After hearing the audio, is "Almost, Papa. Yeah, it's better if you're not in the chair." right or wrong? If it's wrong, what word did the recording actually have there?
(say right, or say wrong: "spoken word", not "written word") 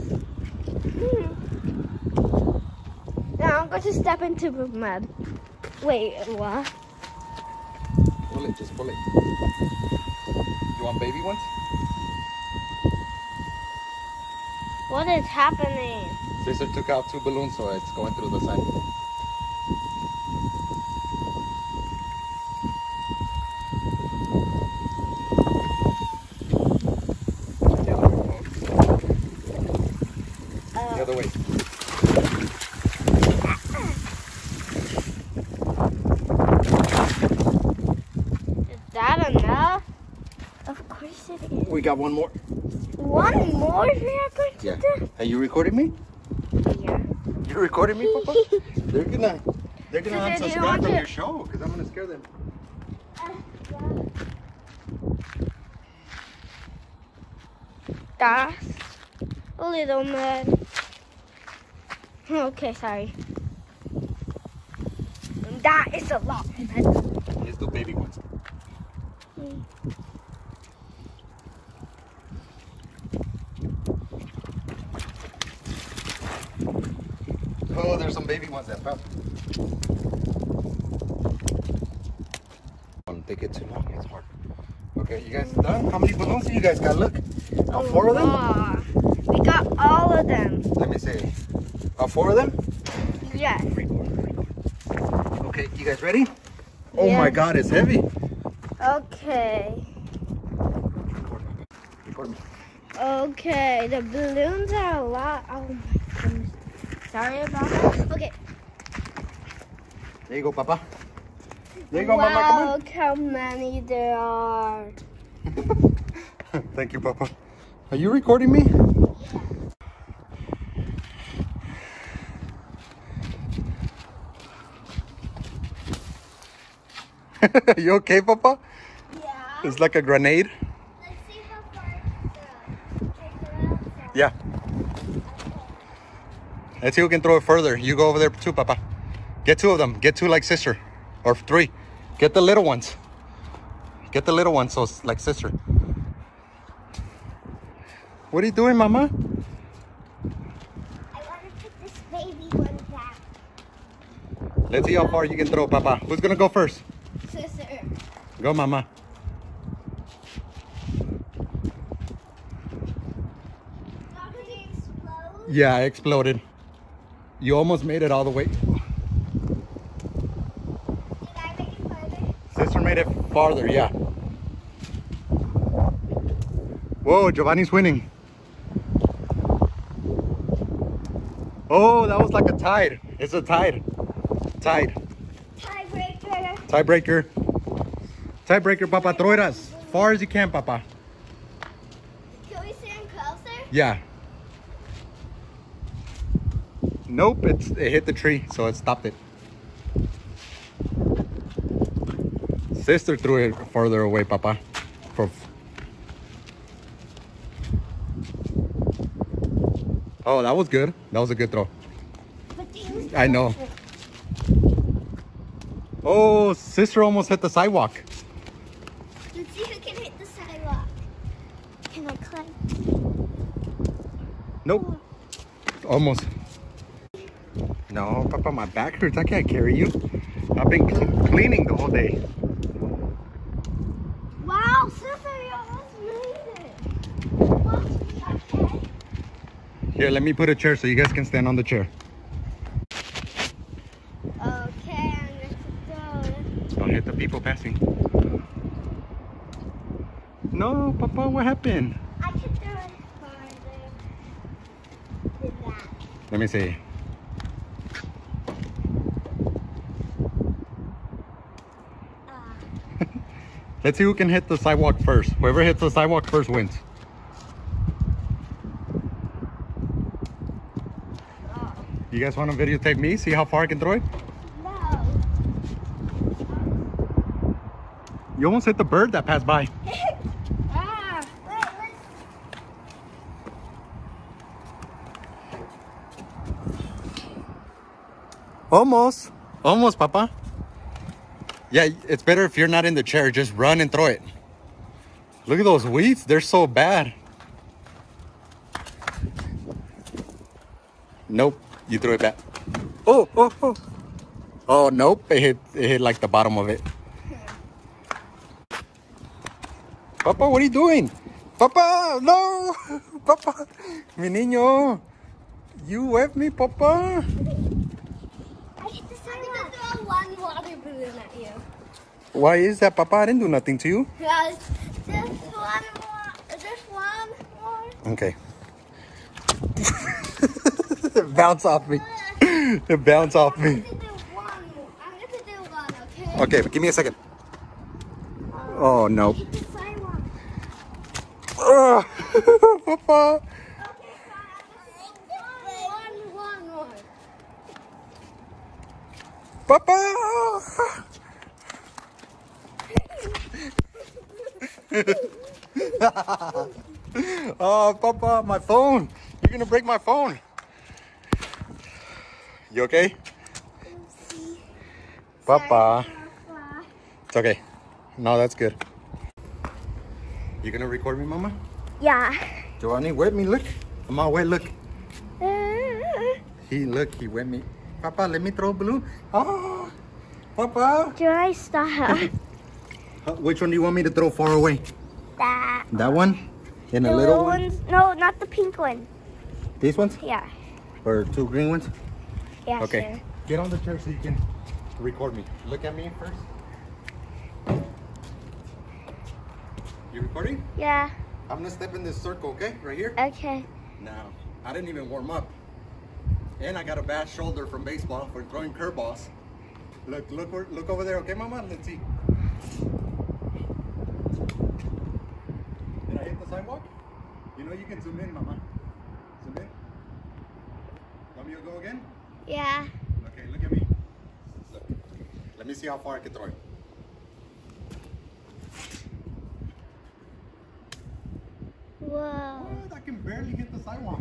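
right.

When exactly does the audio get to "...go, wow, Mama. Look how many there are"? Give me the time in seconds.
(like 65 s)
112 s.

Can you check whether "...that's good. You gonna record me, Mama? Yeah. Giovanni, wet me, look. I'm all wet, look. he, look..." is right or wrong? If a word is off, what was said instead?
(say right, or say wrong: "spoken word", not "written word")
right.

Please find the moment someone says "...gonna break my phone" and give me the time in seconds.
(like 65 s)
359 s.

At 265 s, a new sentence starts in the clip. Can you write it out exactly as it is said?
Whoever hits the sidewalk first wins.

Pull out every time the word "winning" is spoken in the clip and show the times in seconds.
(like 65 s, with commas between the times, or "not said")
177 s.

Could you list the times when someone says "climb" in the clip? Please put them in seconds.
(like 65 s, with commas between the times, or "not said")
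222 s.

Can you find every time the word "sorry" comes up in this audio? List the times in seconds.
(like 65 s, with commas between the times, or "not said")
62 s, 107 s.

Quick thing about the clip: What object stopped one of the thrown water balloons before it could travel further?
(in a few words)
the tree.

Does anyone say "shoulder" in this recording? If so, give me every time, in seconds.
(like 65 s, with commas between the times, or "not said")
407 s.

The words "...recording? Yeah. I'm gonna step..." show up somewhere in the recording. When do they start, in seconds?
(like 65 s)
400 s.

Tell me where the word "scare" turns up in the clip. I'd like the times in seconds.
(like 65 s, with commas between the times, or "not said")
51 s.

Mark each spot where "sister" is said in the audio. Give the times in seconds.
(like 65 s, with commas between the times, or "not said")
16 s, 140 s, 145 s, 157 s, 172 s, 202 s, 216 s, 234 s.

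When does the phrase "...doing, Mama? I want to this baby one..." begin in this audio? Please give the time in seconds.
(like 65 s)
148 s.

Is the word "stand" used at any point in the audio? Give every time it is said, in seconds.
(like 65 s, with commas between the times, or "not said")
192 s, 241 s.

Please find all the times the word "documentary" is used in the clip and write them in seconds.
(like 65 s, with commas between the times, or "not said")
not said.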